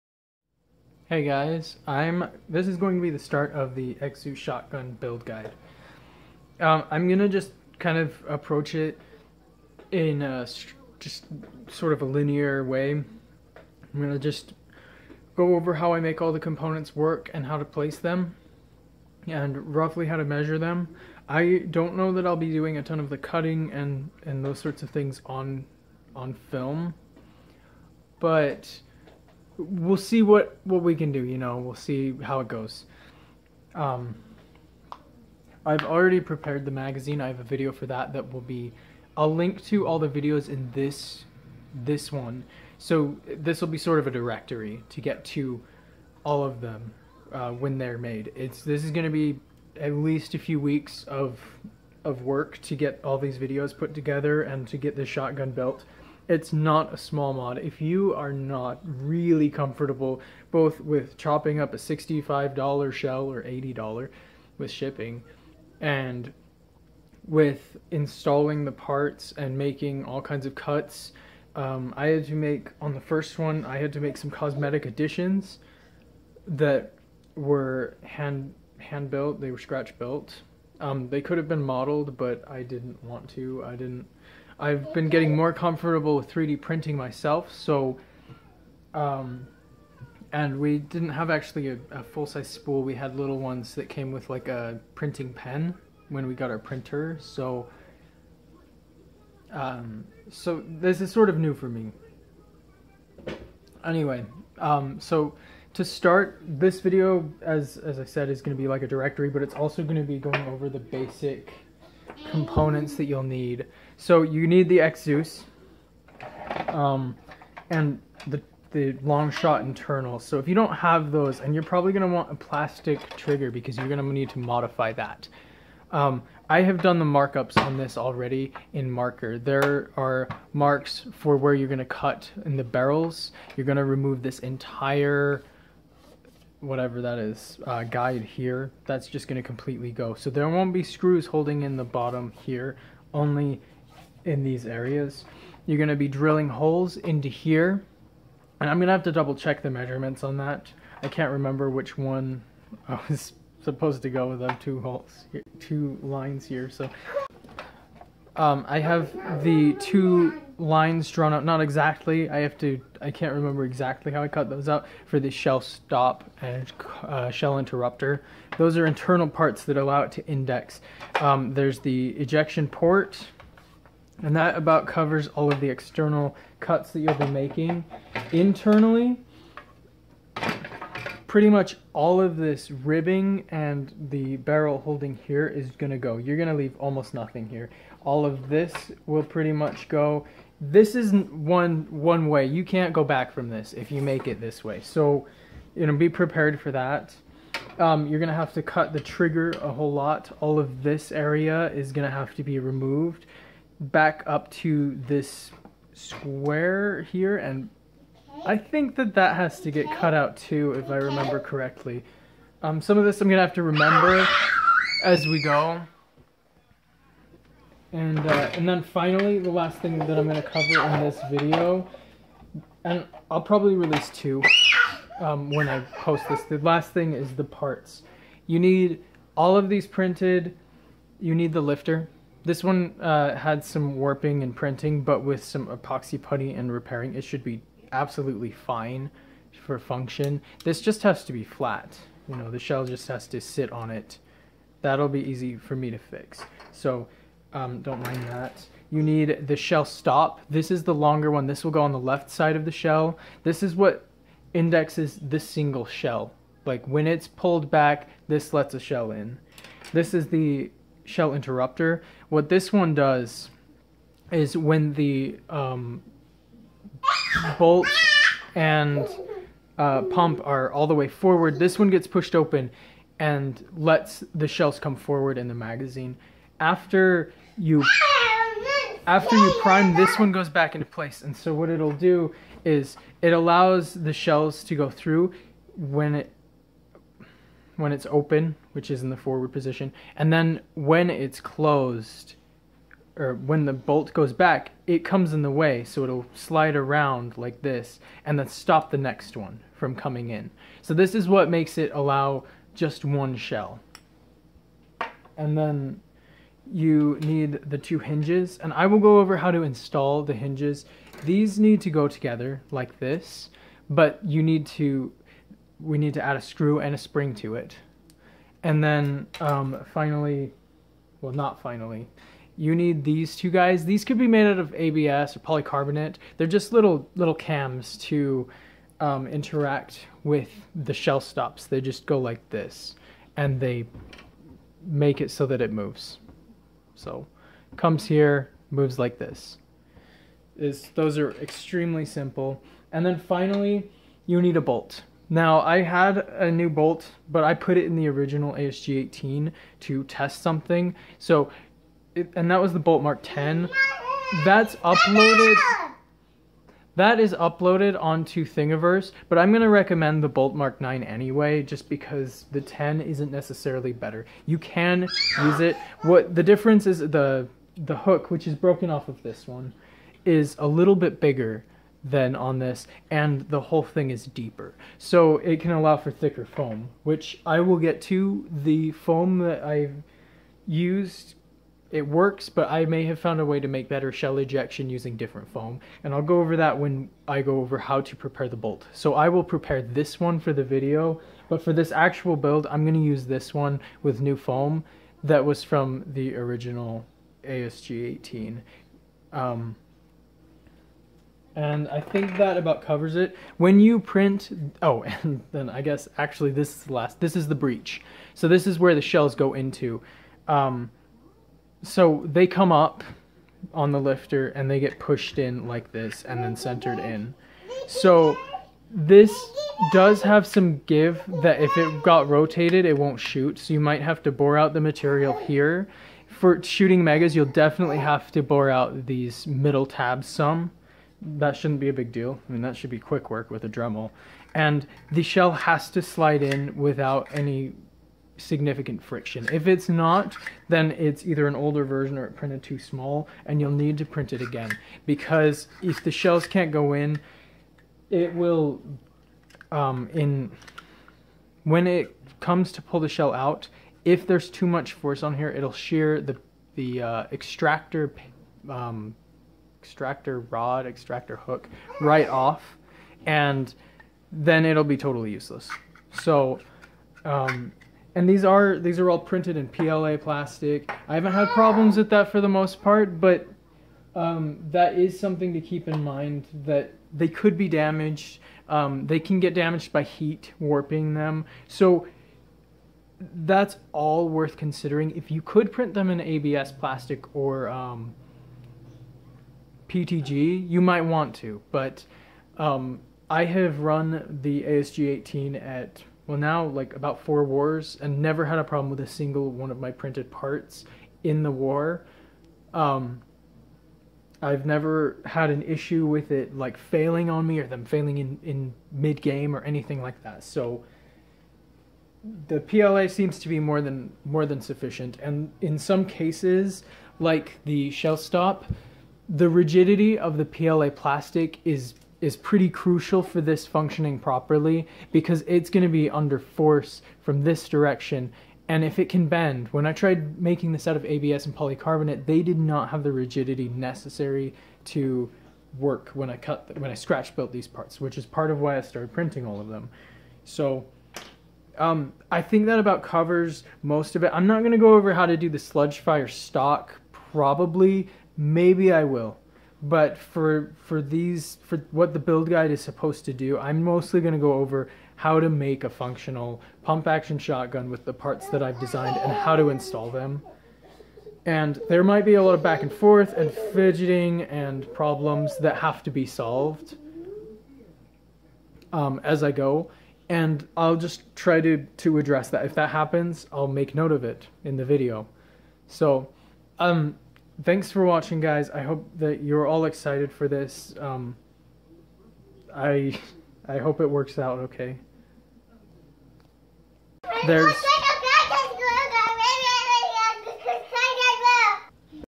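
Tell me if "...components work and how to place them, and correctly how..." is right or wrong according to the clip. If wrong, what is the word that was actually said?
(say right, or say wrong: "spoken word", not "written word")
wrong: "roughly", not "correctly".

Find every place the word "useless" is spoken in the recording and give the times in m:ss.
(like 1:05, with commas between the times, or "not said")
7:45.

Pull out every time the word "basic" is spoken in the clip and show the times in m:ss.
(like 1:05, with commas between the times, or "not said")
1:50.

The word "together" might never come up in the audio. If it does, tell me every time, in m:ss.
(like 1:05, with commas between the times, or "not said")
0:53, 5:12.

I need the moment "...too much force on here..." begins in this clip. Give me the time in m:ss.
7:34.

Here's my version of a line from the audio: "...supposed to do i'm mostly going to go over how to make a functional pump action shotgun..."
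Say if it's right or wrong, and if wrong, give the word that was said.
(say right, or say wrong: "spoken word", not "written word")
right.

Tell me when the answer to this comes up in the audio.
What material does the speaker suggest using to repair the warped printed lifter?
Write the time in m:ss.
3:55.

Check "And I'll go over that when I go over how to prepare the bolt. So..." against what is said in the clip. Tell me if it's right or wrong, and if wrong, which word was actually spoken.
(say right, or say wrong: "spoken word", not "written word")
right.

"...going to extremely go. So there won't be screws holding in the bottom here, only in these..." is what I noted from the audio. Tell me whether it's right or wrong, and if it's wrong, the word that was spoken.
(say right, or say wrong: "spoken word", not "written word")
wrong: "completely", not "extremely".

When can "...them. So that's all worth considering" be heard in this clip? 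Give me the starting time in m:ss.
8:01.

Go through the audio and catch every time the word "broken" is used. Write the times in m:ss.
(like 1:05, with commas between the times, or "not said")
6:08.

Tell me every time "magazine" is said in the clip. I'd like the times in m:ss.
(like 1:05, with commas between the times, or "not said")
0:36, 4:35.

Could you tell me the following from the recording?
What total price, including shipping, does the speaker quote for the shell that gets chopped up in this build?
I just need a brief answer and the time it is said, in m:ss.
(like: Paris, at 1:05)
$80, at 1:03.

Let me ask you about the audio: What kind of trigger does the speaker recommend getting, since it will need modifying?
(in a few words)
plastic trigger.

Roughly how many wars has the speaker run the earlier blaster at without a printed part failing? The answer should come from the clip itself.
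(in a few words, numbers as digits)
4.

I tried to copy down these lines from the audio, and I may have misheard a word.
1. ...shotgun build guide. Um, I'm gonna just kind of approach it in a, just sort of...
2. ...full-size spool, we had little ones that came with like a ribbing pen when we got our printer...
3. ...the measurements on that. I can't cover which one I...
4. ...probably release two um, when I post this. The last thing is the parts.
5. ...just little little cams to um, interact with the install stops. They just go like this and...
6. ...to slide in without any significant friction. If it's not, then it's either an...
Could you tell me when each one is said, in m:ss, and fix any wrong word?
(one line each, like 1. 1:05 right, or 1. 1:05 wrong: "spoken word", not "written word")
1. 0:04 right
2. 1:32 wrong: "printing", not "ribbing"
3. 2:29 wrong: "remember", not "cover"
4. 3:43 right
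5. 5:26 wrong: "shell", not "install"
6. 7:15 right.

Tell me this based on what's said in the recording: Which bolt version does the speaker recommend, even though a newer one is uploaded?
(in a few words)
Bolt Mark 9.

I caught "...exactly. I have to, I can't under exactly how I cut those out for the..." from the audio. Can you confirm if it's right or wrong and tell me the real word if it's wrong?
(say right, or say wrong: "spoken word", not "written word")
wrong: "remember", not "under".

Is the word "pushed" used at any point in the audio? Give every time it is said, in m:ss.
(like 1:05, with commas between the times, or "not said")
4:32, 6:54.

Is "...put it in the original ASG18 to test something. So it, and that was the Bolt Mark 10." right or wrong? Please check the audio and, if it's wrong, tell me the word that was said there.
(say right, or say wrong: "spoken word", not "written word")
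right.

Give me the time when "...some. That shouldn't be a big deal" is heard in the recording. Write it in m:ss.
7:10.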